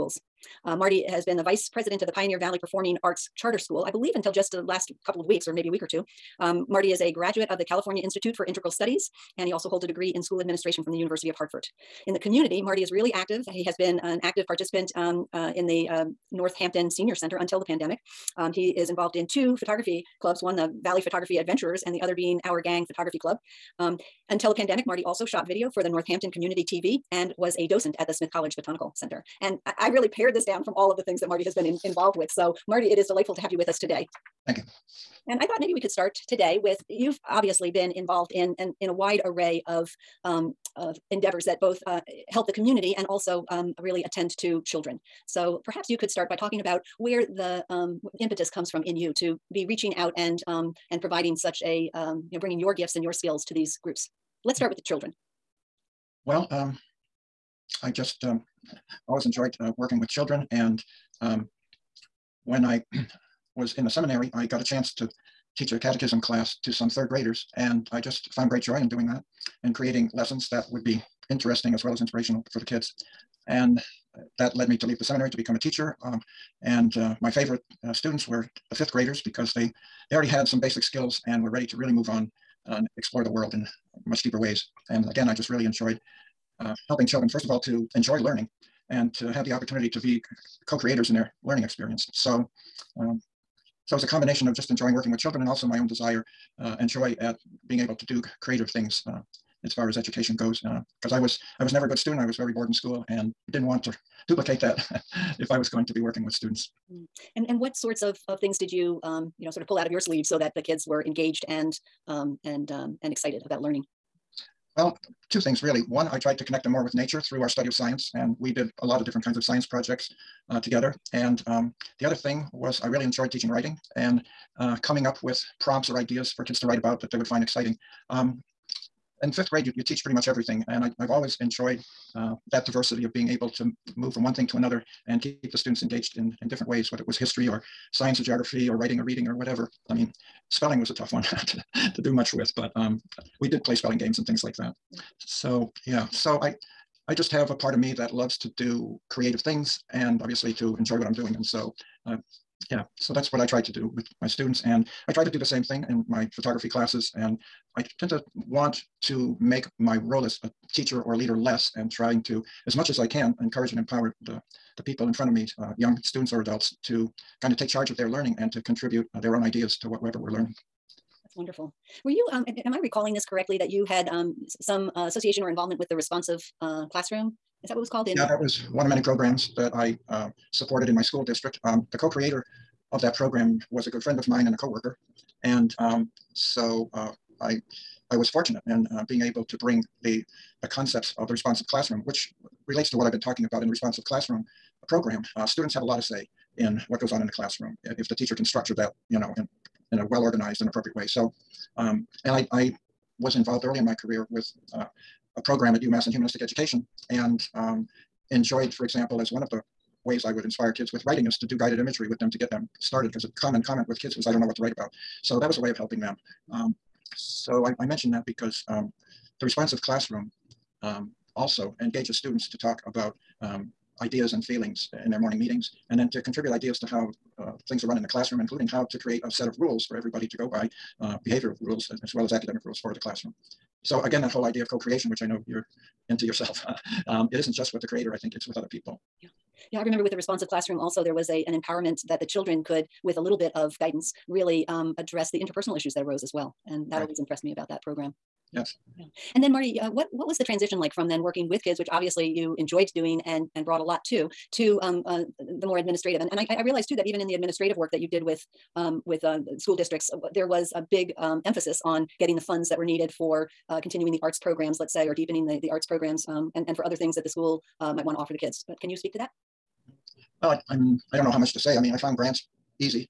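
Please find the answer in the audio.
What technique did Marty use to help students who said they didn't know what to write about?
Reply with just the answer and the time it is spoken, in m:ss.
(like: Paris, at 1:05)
Guided imagery, at 3:31.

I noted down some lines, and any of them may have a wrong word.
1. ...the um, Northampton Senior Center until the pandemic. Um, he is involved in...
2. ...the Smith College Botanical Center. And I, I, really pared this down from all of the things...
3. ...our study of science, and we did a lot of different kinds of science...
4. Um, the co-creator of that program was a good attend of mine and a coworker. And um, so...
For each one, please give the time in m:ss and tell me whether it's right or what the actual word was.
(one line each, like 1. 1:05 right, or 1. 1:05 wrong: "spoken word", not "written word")
1. 0:15 right
2. 0:28 right
3. 1:57 right
4. 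3:01 wrong: "friend", not "attend".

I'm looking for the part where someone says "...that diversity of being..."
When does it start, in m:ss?
2:12.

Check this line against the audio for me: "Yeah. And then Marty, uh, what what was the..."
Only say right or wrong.
right.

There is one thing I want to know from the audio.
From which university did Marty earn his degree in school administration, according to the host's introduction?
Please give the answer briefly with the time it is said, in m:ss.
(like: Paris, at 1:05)
University of Hartford, at 0:10.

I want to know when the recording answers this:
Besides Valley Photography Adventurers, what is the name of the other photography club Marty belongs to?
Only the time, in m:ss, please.
0:22.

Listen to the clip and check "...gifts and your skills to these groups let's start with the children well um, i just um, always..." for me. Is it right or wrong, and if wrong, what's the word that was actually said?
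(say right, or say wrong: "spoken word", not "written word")
right.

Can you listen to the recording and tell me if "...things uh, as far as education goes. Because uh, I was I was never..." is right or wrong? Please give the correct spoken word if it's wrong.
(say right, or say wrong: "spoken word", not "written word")
right.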